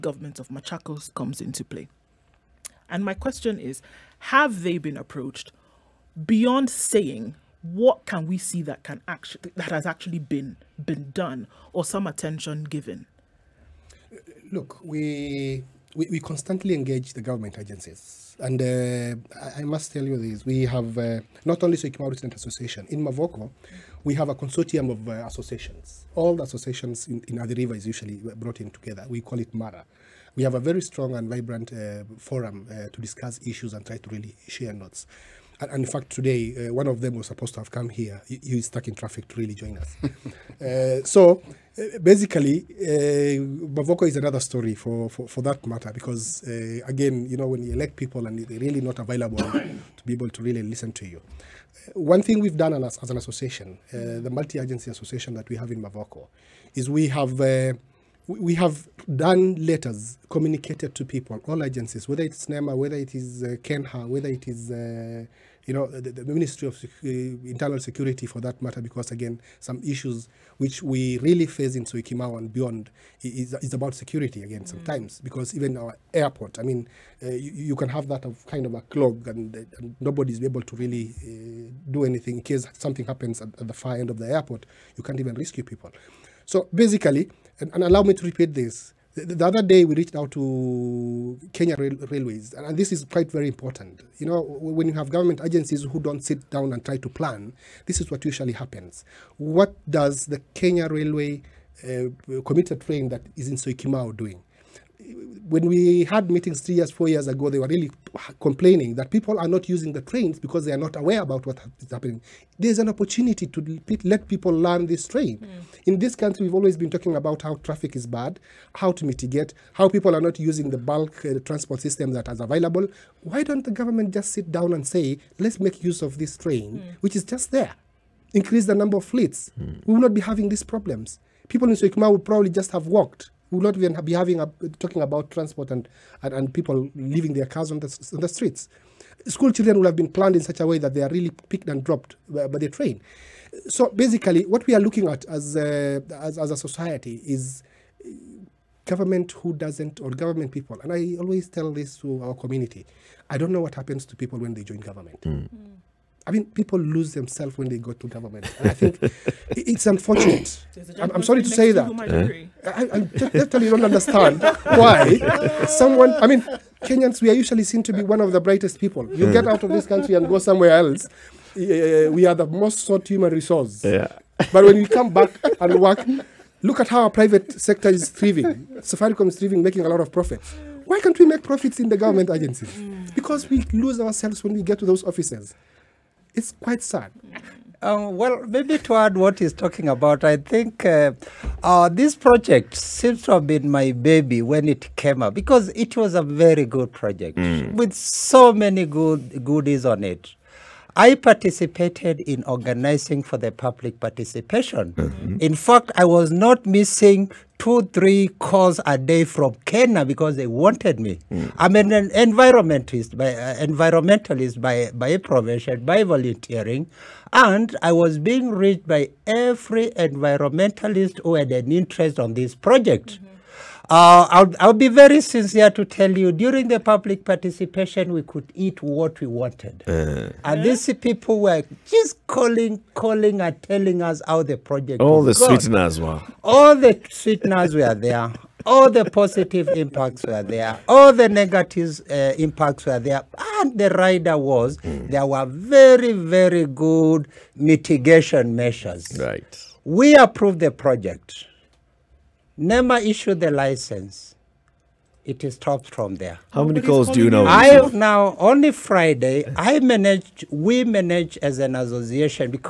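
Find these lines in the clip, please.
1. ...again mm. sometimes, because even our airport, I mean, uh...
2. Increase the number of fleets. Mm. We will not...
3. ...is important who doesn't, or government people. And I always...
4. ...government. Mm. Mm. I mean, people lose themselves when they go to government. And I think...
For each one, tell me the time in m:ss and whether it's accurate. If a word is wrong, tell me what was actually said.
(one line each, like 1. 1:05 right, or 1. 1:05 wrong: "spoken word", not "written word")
1. 1:14 right
2. 2:08 right
3. 2:27 wrong: "government", not "important"
4. 2:34 right.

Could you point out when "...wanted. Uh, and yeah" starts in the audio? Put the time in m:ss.
3:49.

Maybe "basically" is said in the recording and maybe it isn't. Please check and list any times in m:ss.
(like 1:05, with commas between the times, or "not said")
0:42, 1:26, 2:23.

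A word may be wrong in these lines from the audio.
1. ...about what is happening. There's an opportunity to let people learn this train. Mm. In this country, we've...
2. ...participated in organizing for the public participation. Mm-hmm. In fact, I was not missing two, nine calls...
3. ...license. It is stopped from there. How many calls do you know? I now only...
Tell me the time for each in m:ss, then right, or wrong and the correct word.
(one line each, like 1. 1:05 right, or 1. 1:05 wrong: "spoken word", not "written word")
1. 1:51 right
2. 3:21 wrong: "three", not "nine"
3. 4:13 right.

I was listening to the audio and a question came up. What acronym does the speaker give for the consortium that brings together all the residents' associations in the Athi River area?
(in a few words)
MARA.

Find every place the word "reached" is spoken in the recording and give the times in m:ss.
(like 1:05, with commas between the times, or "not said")
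1:29, 3:38.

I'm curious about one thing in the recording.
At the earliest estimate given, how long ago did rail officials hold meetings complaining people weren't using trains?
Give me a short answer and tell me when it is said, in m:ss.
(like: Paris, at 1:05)
4 years, at 1:46.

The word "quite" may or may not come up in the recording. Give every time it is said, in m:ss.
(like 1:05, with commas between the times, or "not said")
1:33, 3:06.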